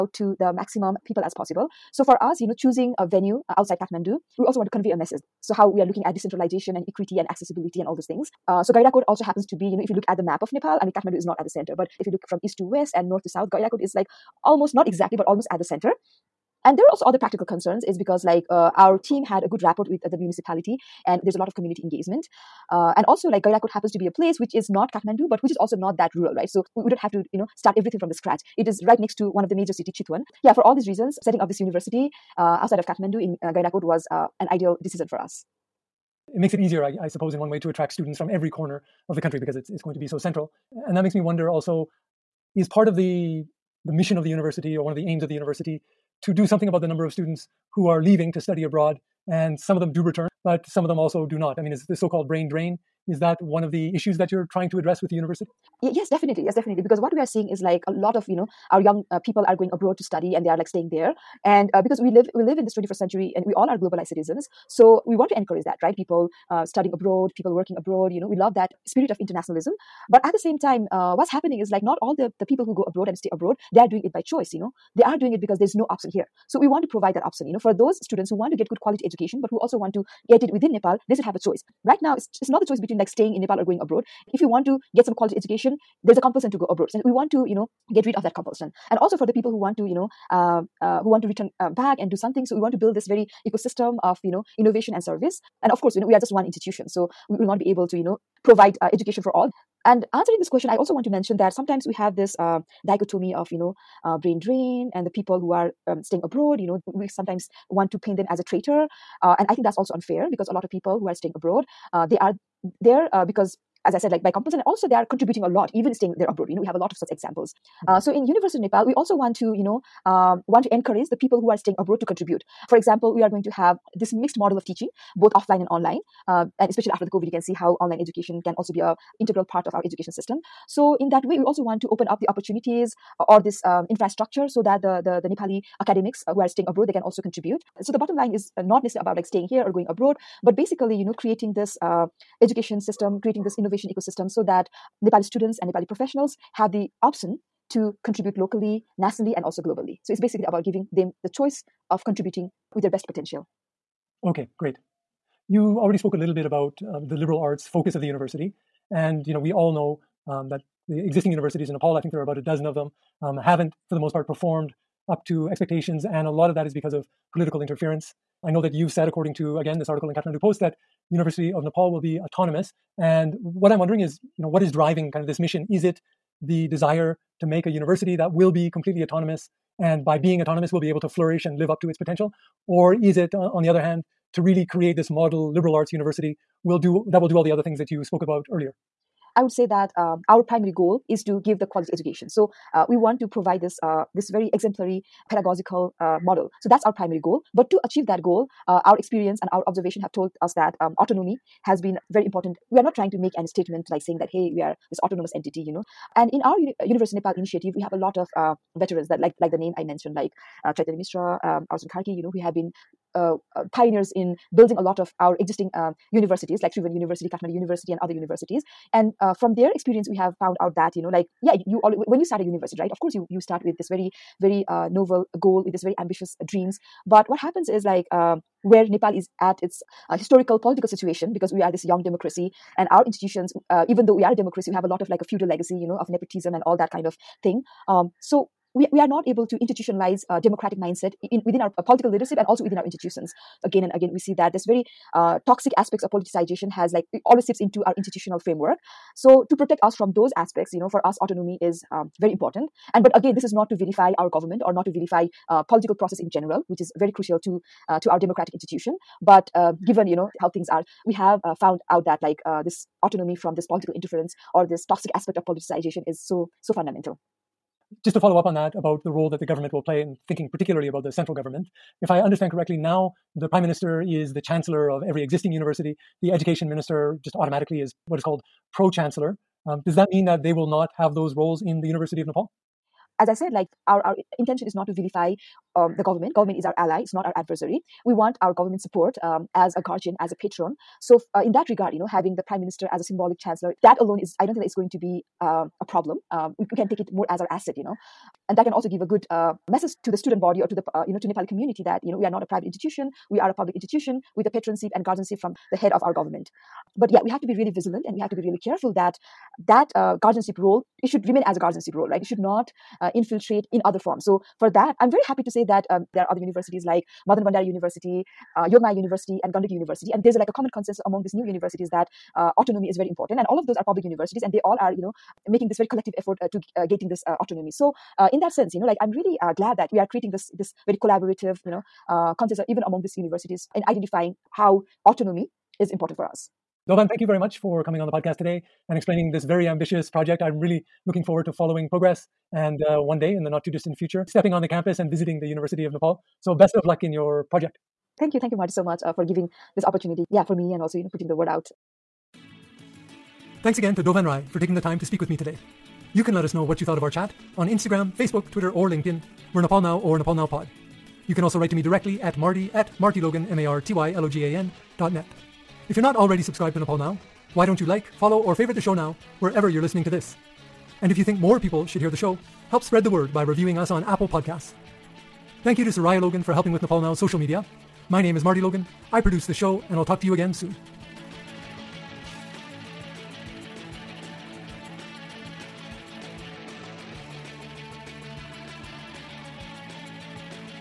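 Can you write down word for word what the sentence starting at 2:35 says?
You already spoke a little bit about uh, the liberal arts focus of the university.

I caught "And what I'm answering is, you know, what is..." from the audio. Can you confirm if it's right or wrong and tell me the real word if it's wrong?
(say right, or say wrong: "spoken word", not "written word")
wrong: "wondering", not "answering".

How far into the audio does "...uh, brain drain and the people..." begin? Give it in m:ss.
1:44.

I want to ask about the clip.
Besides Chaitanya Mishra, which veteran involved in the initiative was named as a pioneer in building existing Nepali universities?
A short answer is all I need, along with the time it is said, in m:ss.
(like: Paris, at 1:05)
Arjun Karki, at 3:31.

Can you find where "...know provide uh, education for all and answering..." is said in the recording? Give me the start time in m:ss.
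1:38.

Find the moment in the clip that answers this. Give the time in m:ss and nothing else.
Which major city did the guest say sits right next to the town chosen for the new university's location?
0:29.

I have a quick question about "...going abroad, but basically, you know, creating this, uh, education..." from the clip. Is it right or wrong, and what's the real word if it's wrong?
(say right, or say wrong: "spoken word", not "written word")
right.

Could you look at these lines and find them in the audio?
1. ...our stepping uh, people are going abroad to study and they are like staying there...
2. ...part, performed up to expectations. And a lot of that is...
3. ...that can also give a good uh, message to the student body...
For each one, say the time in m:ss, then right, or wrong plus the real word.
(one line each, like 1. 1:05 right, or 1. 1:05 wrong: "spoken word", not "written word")
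1. 0:58 wrong: "young", not "stepping"
2. 2:44 right
3. 4:58 right.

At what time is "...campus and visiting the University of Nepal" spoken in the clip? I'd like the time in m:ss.
5:44.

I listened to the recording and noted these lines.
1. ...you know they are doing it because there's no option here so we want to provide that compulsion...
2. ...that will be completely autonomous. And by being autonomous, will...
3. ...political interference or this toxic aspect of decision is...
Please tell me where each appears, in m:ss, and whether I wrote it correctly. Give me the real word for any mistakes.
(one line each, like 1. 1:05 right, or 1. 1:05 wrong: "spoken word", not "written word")
1. 1:14 wrong: "option", not "compulsion"
2. 2:58 right
3. 4:23 wrong: "politicization", not "decision".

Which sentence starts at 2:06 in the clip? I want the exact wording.
Uh, and especially after the COVID, you can see how online education can also be a integral part of our education system.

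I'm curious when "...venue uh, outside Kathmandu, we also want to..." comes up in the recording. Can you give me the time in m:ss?
0:03.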